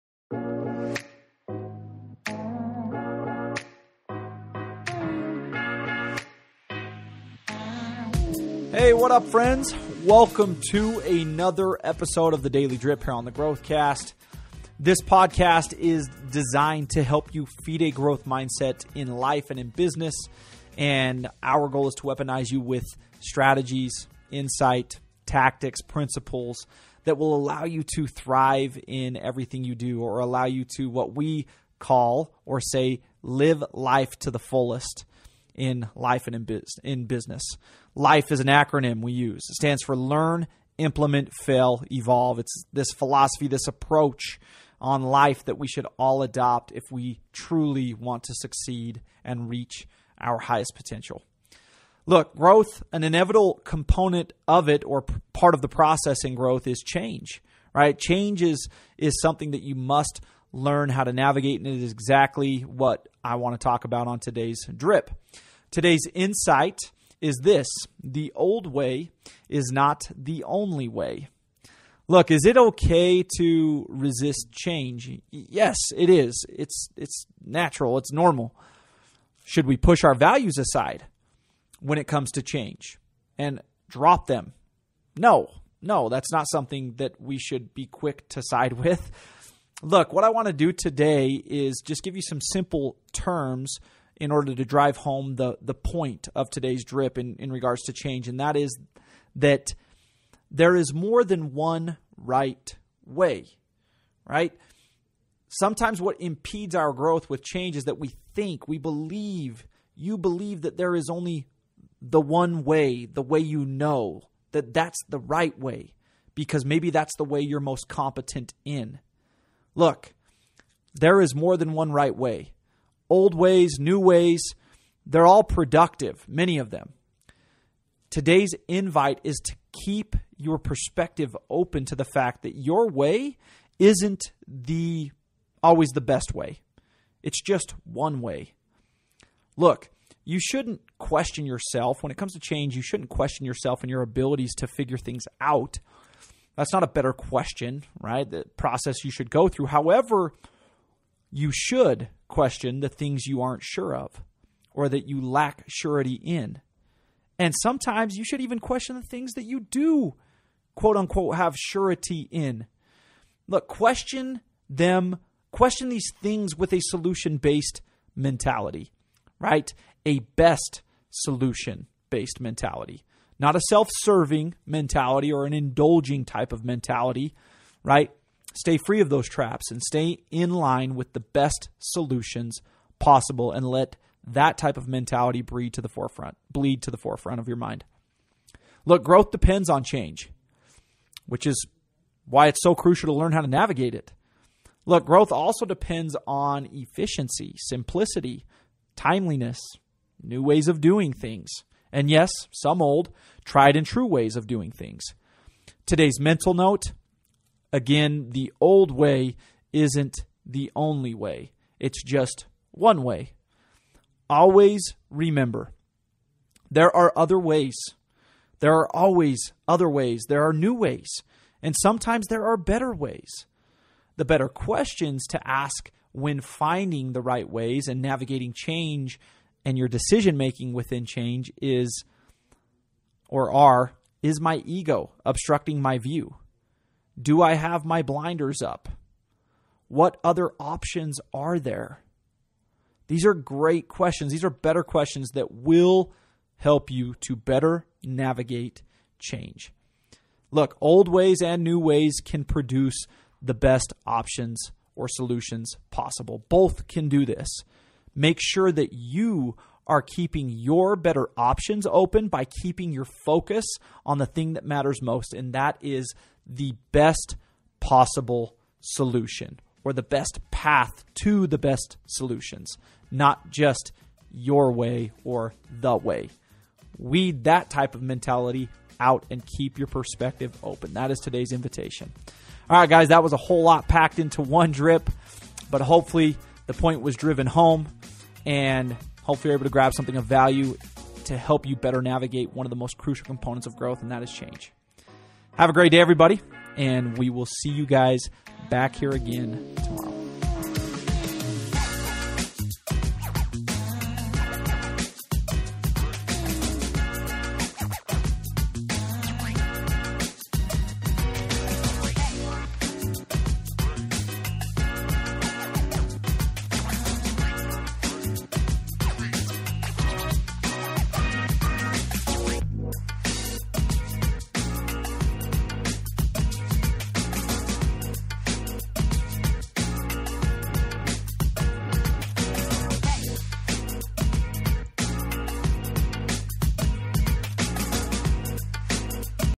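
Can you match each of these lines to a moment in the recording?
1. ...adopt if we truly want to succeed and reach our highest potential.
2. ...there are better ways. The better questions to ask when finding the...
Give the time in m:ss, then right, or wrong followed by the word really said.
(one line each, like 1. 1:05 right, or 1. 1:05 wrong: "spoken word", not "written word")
1. 0:46 right
2. 3:42 right.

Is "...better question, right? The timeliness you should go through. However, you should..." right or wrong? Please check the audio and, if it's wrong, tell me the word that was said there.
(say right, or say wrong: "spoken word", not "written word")
wrong: "process", not "timeliness".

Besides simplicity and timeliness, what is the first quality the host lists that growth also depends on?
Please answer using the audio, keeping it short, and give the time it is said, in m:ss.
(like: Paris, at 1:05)
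efficiency, at 3:16.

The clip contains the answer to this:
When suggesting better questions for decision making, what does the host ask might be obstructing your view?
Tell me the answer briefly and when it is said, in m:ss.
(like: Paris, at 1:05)
ego, at 3:54.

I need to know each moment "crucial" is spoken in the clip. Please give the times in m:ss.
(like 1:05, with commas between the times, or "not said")
3:12, 4:52.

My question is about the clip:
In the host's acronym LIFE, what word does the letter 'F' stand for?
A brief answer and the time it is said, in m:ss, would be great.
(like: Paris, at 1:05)
fail, at 0:41.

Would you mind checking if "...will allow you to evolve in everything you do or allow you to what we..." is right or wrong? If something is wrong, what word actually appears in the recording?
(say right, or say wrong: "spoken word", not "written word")
wrong: "thrive", not "evolve".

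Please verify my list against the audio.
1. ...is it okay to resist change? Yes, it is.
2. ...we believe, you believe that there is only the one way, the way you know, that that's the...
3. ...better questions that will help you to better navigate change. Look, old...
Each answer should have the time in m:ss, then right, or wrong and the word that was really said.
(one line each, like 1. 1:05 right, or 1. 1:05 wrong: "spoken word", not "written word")
1. 1:12 right
2. 1:48 right
3. 4:04 right.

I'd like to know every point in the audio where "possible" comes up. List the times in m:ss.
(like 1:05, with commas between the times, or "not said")
3:02, 4:15, 4:27.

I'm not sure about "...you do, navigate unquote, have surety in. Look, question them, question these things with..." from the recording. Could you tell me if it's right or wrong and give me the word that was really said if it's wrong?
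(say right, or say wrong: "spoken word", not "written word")
wrong: "quote", not "navigate".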